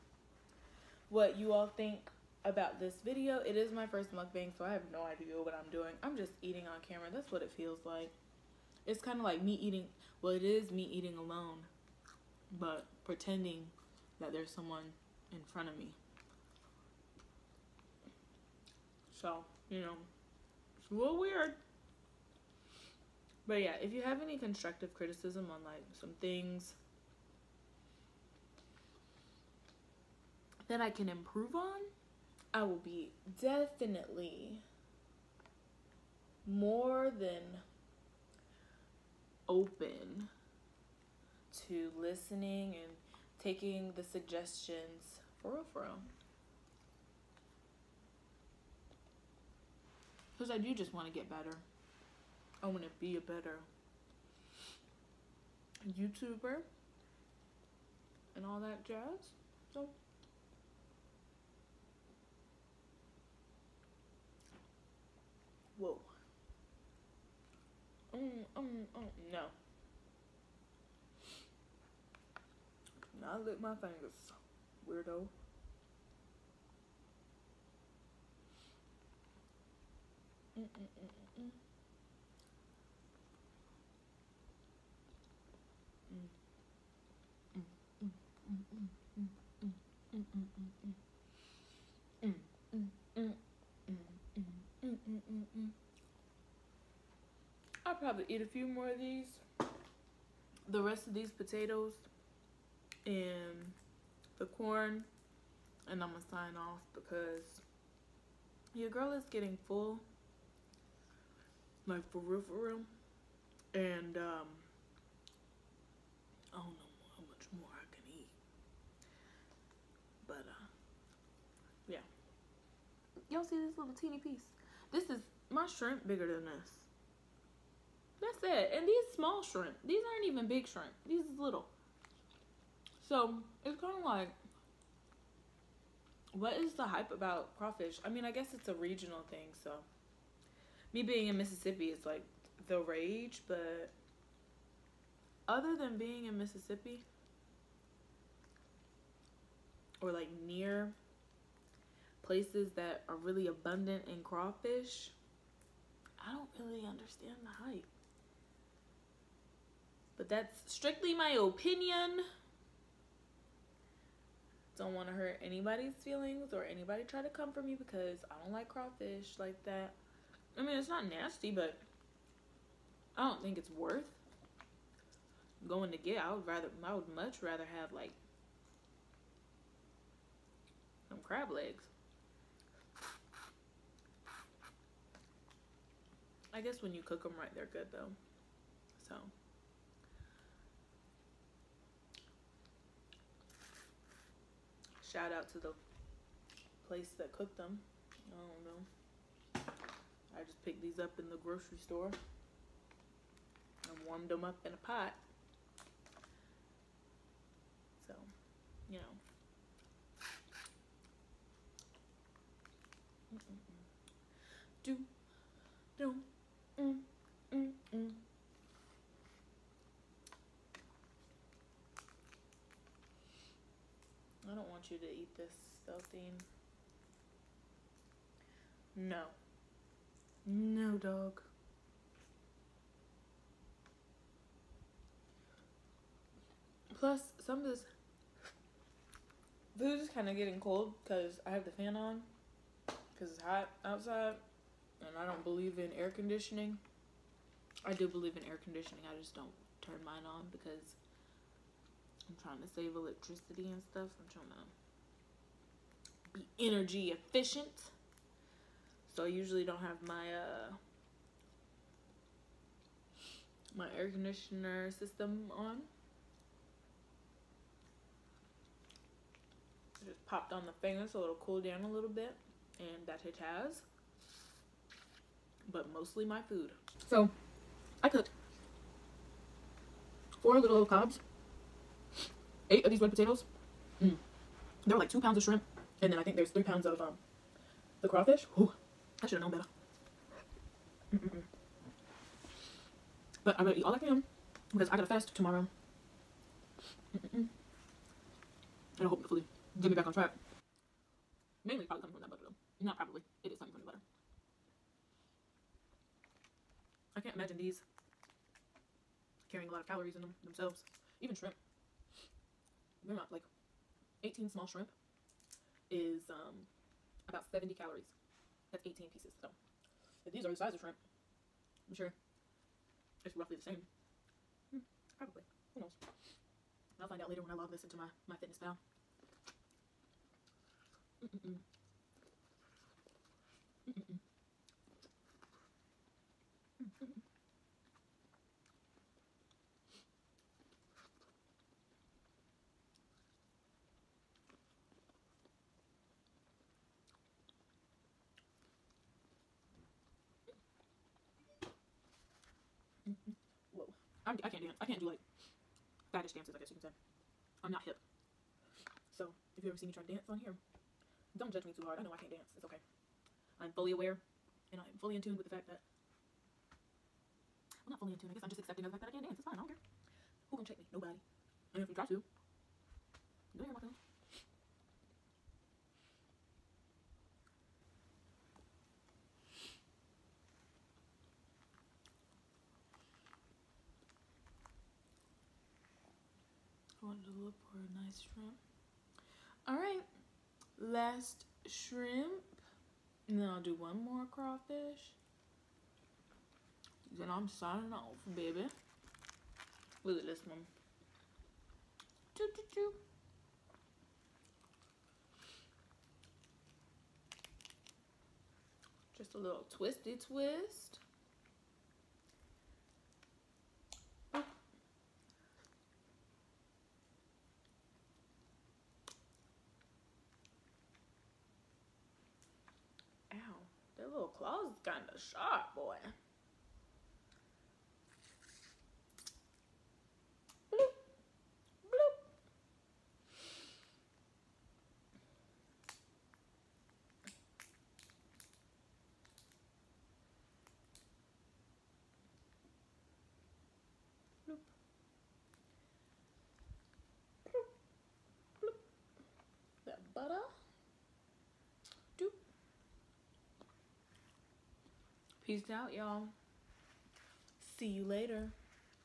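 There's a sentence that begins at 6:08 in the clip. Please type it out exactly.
I guess I'm just accepting the fact that I can't dance.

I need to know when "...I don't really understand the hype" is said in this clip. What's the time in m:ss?
2:36.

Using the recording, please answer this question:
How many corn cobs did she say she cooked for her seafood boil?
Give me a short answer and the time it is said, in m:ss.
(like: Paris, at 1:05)
4, at 4:40.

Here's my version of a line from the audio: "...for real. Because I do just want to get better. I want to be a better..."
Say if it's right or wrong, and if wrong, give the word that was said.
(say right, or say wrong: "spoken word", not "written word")
right.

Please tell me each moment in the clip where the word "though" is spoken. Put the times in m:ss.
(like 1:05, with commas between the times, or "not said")
3:07, 5:02.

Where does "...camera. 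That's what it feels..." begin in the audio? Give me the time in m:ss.
0:06.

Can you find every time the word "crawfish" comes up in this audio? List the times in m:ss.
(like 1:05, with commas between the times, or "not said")
2:17, 2:34, 2:48, 4:48, 6:34.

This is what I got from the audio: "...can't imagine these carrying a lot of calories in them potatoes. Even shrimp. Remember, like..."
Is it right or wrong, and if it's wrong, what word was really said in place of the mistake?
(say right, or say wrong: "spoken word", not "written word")
wrong: "themselves", not "potatoes".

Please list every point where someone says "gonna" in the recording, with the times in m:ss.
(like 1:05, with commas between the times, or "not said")
4:53, 6:10.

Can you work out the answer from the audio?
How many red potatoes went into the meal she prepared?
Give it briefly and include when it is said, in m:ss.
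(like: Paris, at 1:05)
8, at 4:42.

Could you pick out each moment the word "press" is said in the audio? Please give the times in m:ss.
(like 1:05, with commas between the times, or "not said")
not said.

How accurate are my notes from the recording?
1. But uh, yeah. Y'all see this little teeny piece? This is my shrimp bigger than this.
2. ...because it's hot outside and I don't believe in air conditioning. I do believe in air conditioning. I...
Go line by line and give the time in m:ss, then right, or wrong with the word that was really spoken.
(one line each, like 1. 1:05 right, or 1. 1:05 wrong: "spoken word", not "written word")
1. 2:00 right
2. 4:02 right.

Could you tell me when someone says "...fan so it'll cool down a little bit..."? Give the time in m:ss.
4:30.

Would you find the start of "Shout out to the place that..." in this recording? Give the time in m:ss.
3:15.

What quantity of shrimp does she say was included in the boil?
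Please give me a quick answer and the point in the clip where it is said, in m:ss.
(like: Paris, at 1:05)
2 pounds, at 4:45.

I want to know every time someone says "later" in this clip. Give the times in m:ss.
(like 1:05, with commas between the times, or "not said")
5:27, 7:38.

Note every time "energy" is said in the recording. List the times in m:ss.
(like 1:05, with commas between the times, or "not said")
4:16.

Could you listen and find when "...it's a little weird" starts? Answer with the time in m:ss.
0:20.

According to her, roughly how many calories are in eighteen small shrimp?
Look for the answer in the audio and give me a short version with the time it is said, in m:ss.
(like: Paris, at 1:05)
70, at 5:17.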